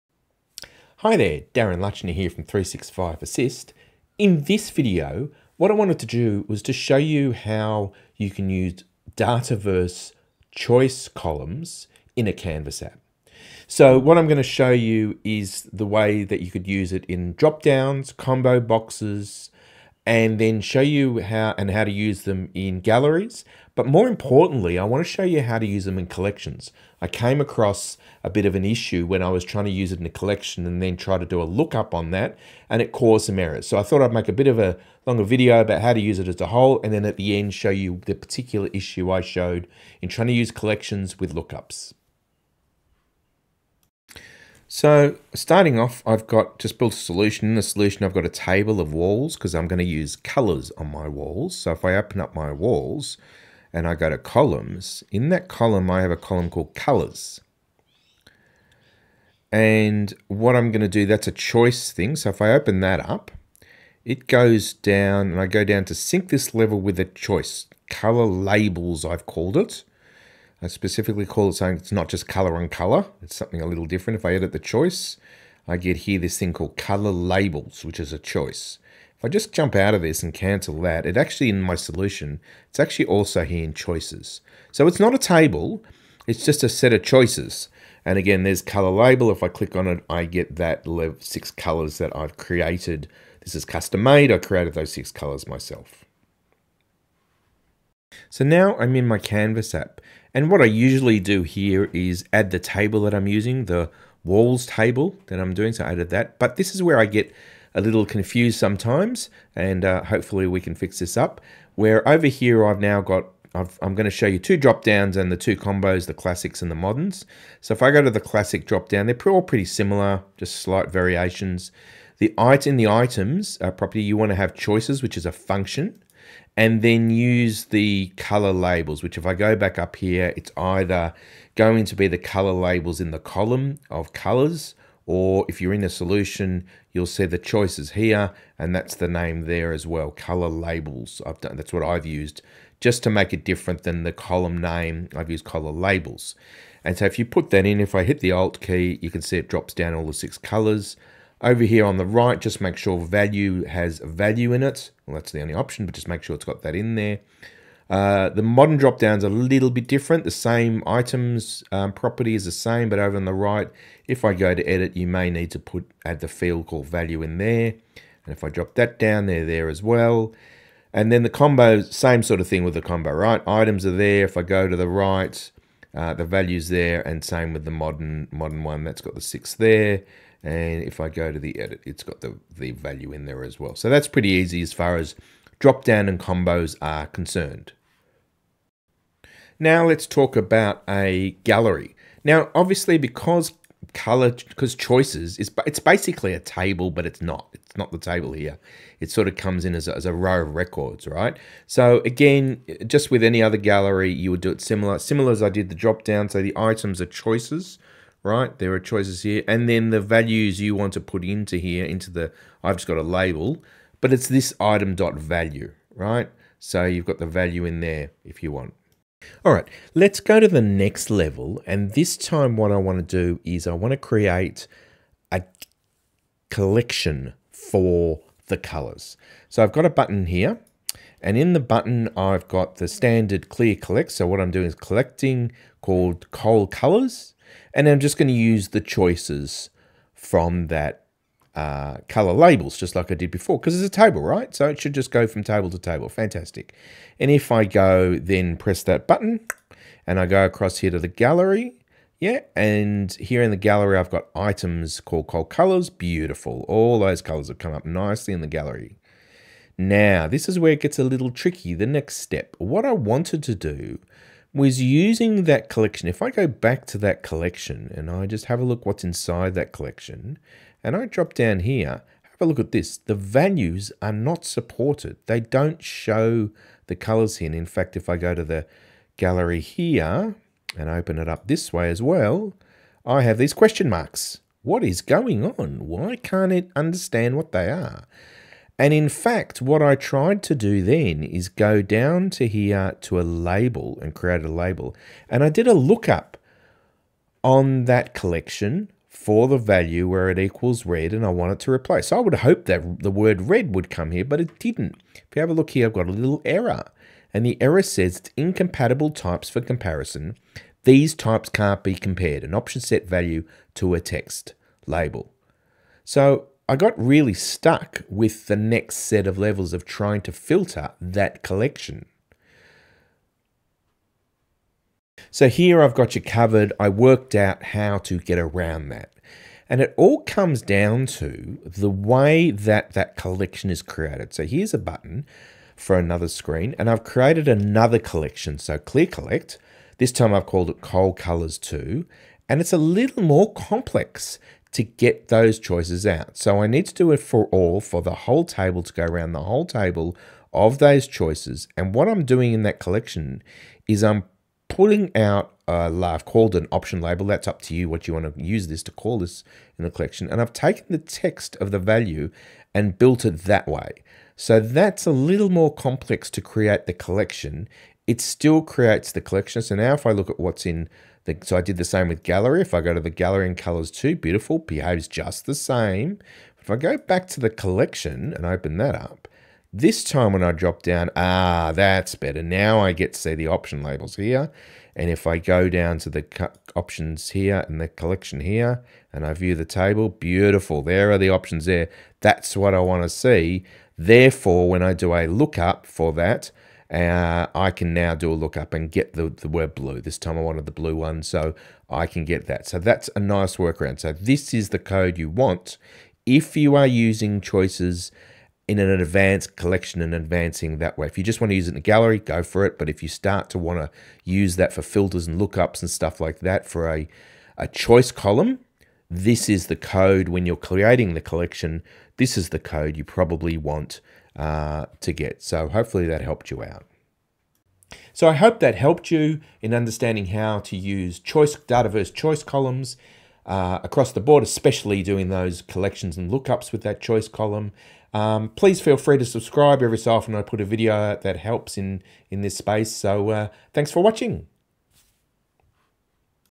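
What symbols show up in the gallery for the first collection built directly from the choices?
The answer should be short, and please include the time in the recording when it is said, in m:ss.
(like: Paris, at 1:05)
question marks, at 4:43.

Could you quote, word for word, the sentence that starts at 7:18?
Um, please feel free to subscribe.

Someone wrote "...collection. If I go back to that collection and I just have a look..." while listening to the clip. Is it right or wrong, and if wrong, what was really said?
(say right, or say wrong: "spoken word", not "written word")
right.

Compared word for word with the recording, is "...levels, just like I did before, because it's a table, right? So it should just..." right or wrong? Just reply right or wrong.
wrong.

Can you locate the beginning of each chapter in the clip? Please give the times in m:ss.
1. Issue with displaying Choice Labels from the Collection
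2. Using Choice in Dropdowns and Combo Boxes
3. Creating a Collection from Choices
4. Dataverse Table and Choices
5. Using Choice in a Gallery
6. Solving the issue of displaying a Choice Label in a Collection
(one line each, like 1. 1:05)
1. 4:19
2. 1:38
3. 3:39
4. 0:44
5. 3:09
6. 5:25.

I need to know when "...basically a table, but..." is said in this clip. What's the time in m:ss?
3:15.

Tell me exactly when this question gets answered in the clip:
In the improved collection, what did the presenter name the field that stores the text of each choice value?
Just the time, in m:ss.
5:56.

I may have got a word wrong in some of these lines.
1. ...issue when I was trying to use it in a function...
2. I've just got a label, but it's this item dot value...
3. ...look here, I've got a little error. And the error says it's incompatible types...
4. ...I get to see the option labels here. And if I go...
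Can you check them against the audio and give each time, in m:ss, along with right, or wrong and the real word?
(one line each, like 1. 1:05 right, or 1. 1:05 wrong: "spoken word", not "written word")
1. 0:28 wrong: "collection", not "function"
2. 3:32 right
3. 5:05 right
4. 6:22 right.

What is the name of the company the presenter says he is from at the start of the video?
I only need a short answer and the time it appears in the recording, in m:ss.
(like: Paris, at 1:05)
365 Assist, at 0:02.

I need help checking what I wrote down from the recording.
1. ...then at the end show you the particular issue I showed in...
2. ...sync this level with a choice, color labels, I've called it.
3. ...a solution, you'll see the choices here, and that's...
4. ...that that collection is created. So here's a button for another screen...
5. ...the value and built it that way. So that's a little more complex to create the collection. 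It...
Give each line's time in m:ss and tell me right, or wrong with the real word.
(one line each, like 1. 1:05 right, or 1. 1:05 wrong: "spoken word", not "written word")
1. 0:36 right
2. 1:05 right
3. 2:15 right
4. 5:32 right
5. 6:01 right.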